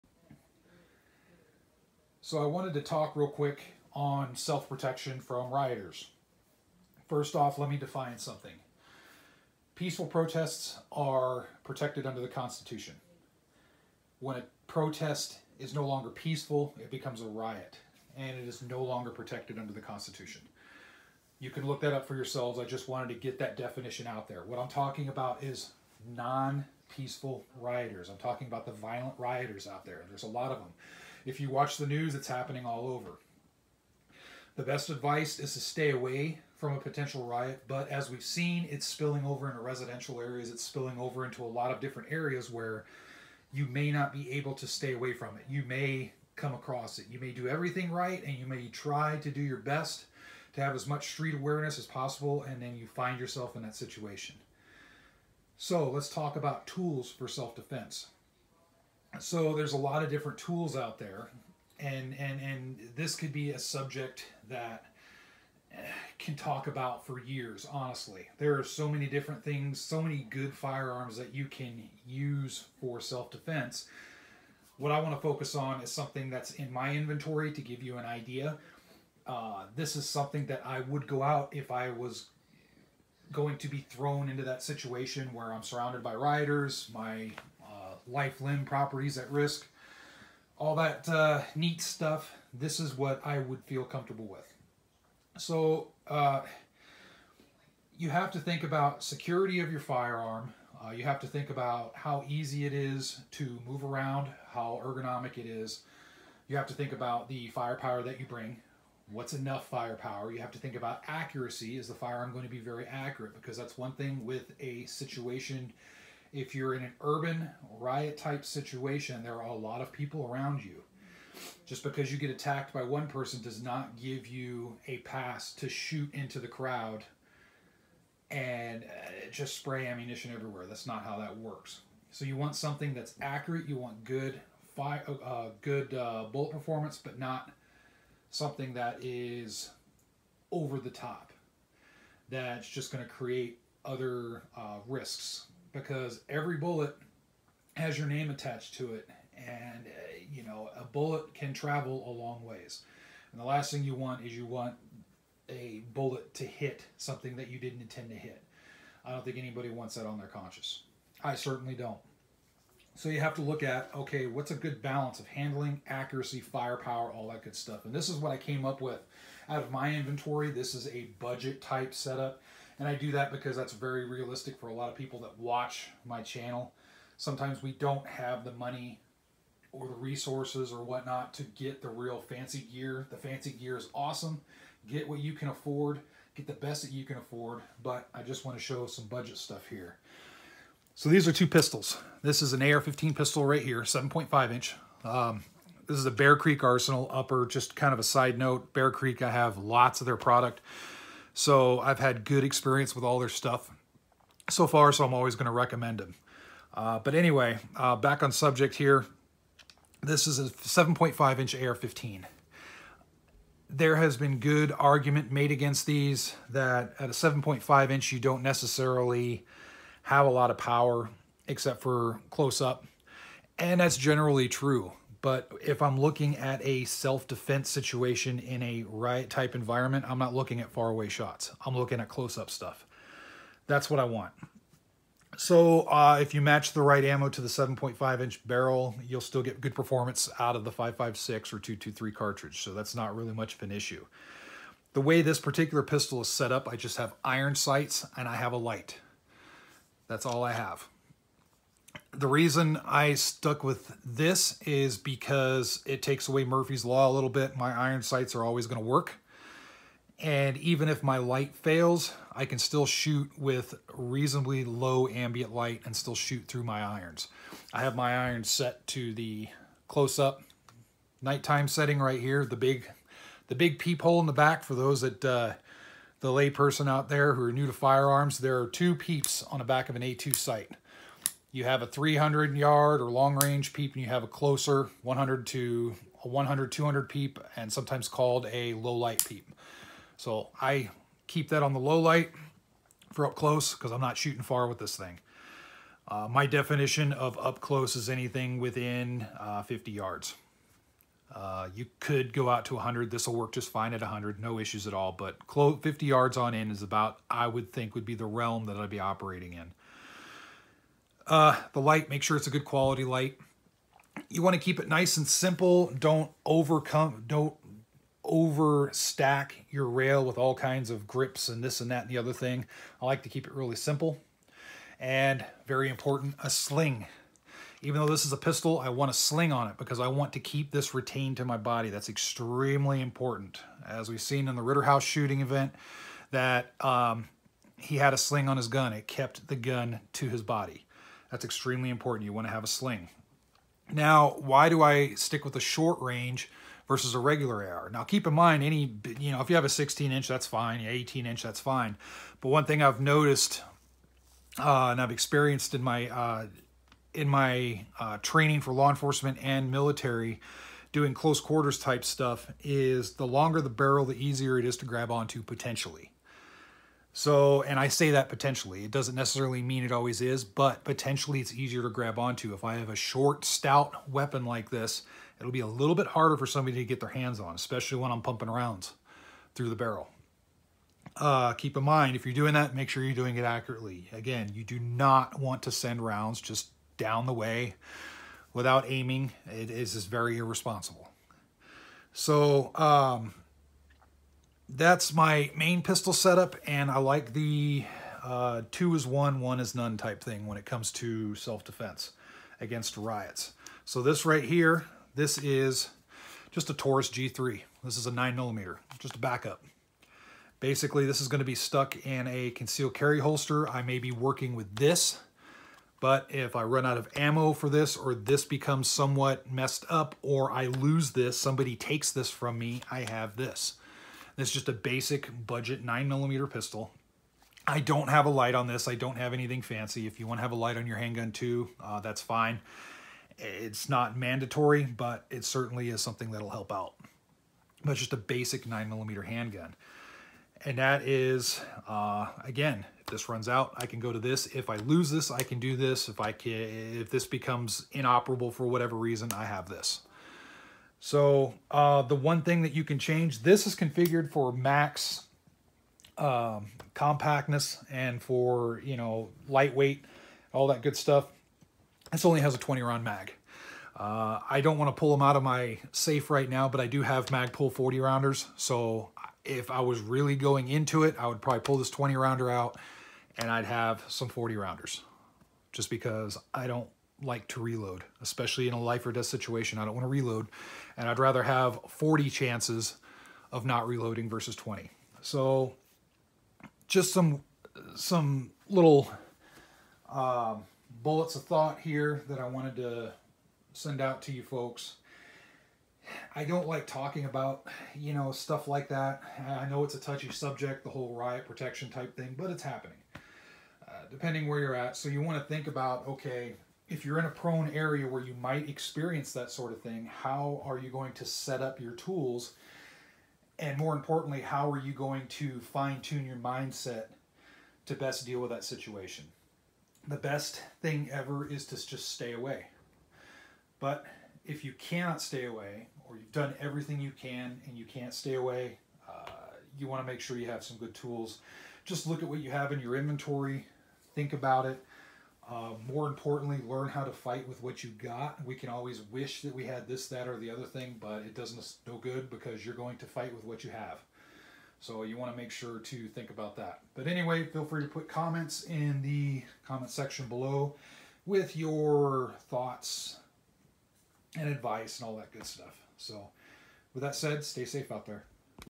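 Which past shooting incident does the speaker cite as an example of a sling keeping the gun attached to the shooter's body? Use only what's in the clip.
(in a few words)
Rittenhouse.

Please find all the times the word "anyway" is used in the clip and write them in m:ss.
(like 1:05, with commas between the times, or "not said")
3:27, 9:07.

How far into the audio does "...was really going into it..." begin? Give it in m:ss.
7:49.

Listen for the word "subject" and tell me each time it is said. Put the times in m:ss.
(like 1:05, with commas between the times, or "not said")
1:03, 3:28, 8:20.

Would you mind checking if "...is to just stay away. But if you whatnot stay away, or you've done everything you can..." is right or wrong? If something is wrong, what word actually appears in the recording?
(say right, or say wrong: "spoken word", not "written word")
wrong: "cannot", not "whatnot".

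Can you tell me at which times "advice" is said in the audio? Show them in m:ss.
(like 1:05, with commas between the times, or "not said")
0:34, 9:14.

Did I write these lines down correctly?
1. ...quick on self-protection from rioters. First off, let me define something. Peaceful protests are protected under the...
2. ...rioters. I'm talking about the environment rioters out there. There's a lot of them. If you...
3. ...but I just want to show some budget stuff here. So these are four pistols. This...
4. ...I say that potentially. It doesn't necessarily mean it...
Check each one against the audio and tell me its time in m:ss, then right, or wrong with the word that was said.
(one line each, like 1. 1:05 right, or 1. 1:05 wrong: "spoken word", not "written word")
1. 0:03 right
2. 0:27 wrong: "violent", not "environment"
3. 3:07 wrong: "two", not "four"
4. 6:07 right.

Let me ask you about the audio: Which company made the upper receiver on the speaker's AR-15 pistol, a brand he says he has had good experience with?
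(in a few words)
Bear Creek Arsenal.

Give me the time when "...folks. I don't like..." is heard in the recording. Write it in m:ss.
8:14.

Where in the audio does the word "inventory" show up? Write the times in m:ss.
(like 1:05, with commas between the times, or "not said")
1:16, 2:49, 8:52.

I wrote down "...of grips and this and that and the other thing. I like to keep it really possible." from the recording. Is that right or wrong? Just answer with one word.
wrong.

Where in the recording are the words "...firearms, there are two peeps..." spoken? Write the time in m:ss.
4:37.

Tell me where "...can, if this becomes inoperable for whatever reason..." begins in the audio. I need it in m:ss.
7:26.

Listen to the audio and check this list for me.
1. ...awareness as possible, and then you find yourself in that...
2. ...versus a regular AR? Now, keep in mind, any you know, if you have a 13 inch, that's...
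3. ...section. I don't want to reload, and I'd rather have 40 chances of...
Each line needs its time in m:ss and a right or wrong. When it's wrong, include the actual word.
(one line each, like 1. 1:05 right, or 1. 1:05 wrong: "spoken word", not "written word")
1. 0:51 right
2. 5:46 wrong: "16", not "13"
3. 7:59 wrong: "situation", not "section".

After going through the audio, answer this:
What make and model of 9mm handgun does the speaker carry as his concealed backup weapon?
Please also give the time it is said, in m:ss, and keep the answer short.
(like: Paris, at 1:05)
Taurus G3, at 6:46.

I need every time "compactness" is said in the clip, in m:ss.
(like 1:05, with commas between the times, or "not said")
7:36.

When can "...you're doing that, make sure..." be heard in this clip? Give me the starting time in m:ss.
6:22.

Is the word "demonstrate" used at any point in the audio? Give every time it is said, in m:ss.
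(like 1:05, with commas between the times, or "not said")
not said.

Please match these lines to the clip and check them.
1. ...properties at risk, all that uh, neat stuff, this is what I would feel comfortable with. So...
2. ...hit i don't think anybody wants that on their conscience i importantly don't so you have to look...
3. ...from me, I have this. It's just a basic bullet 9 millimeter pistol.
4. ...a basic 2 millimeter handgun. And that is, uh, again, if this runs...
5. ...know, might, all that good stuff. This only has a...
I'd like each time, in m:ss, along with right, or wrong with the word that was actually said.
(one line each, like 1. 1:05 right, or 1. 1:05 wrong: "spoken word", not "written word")
1. 1:28 right
2. 2:38 wrong: "certainly", not "importantly"
3. 7:02 wrong: "budget", not "bullet"
4. 7:18 wrong: "9", not "2"
5. 7:38 wrong: "lightweight", not "might".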